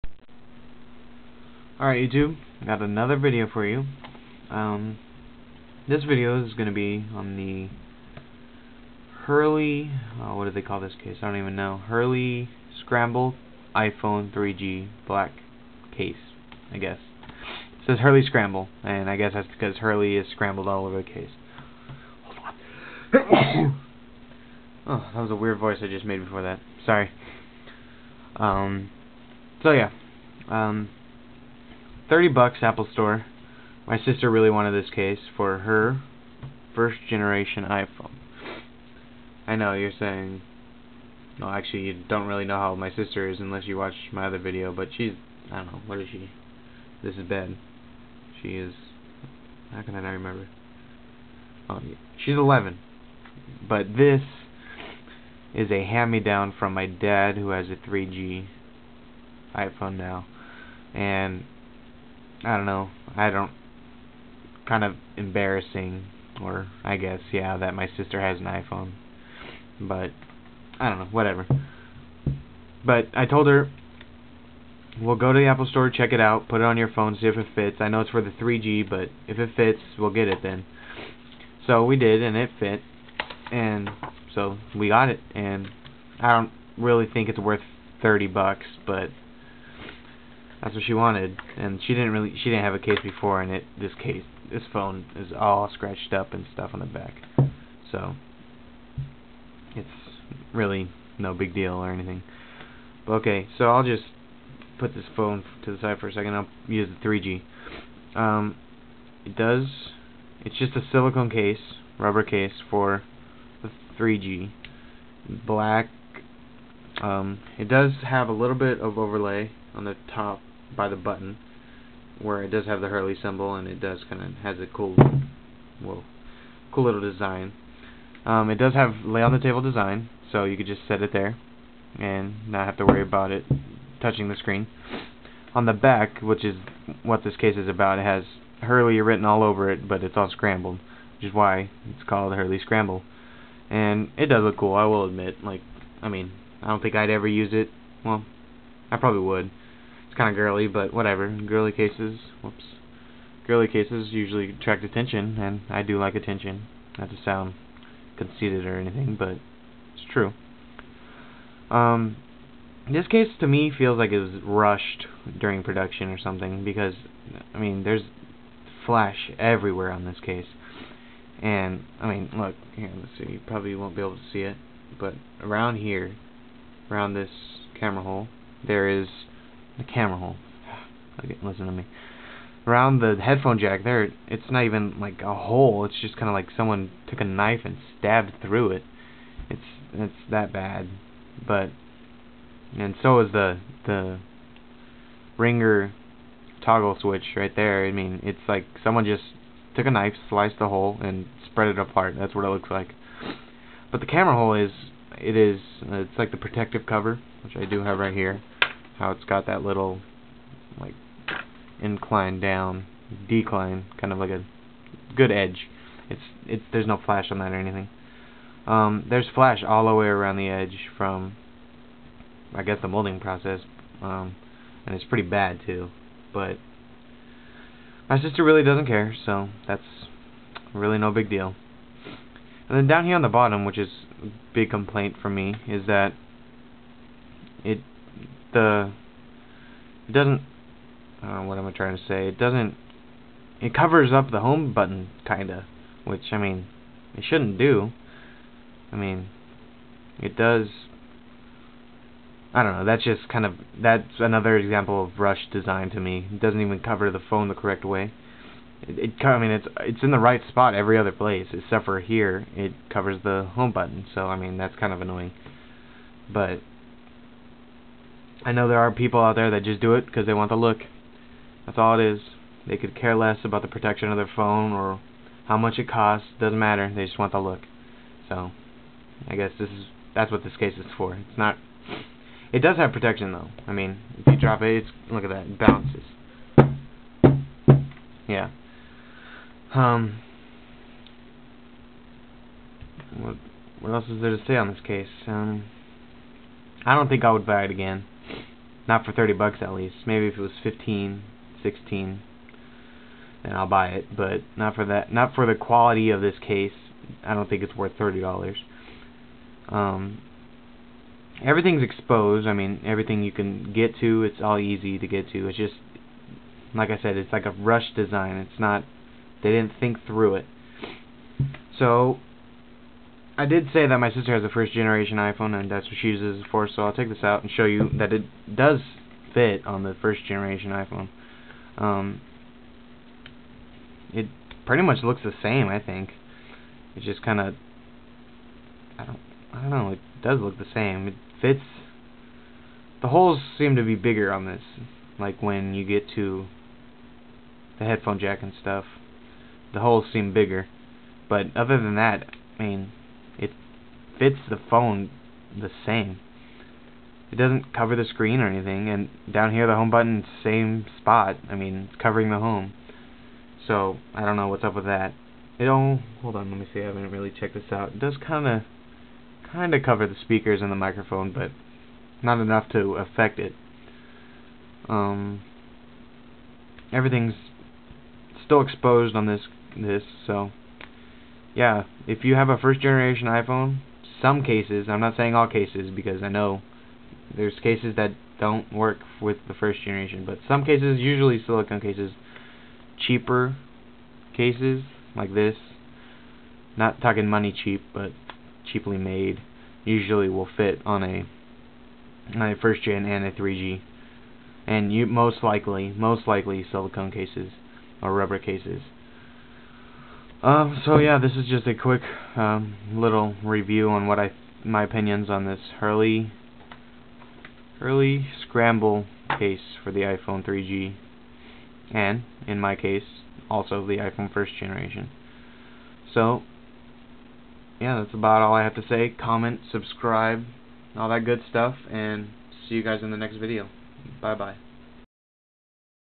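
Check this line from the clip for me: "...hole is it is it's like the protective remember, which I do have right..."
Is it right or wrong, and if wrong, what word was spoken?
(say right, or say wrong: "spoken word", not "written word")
wrong: "cover", not "remember".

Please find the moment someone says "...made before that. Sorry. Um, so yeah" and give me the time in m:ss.
0:26.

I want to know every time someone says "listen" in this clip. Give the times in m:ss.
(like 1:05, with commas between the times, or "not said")
3:01.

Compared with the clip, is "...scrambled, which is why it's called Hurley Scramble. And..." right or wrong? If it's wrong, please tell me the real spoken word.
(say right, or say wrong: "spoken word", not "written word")
right.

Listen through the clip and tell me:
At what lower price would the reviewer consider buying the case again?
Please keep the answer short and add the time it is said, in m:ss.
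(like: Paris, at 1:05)
15 or 16 dollars, at 5:00.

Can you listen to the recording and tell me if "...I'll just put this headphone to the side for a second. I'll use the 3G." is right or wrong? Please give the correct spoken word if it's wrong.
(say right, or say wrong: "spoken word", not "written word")
wrong: "phone", not "headphone".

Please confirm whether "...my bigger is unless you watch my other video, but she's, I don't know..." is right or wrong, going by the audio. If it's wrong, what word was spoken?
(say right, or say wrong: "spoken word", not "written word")
wrong: "sister", not "bigger".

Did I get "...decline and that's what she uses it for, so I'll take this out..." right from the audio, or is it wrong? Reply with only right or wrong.
wrong.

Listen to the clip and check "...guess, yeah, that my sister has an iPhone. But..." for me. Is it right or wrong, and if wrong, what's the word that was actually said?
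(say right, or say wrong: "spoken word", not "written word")
right.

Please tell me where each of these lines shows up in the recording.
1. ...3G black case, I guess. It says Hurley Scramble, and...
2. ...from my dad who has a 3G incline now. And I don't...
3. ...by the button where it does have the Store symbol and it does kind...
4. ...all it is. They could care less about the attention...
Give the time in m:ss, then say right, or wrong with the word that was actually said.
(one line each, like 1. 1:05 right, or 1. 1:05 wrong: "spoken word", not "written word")
1. 0:14 right
2. 0:56 wrong: "iPhone", not "incline"
3. 2:00 wrong: "Hurley", not "Store"
4. 4:31 wrong: "protection", not "attention".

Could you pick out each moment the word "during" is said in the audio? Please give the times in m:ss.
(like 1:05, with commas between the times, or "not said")
2:45.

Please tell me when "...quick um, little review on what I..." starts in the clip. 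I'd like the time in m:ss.
6:51.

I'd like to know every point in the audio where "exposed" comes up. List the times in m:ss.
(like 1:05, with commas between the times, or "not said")
5:11, 6:18.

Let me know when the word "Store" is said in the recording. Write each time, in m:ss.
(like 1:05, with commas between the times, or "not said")
0:32, 1:15.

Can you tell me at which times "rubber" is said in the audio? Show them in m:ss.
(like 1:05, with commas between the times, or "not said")
1:51, 6:48.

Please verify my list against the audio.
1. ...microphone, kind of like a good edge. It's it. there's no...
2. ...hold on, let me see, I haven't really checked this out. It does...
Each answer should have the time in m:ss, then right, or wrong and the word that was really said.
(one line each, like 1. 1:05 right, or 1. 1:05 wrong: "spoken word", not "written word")
1. 3:33 wrong: "decline", not "microphone"
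2. 6:06 right.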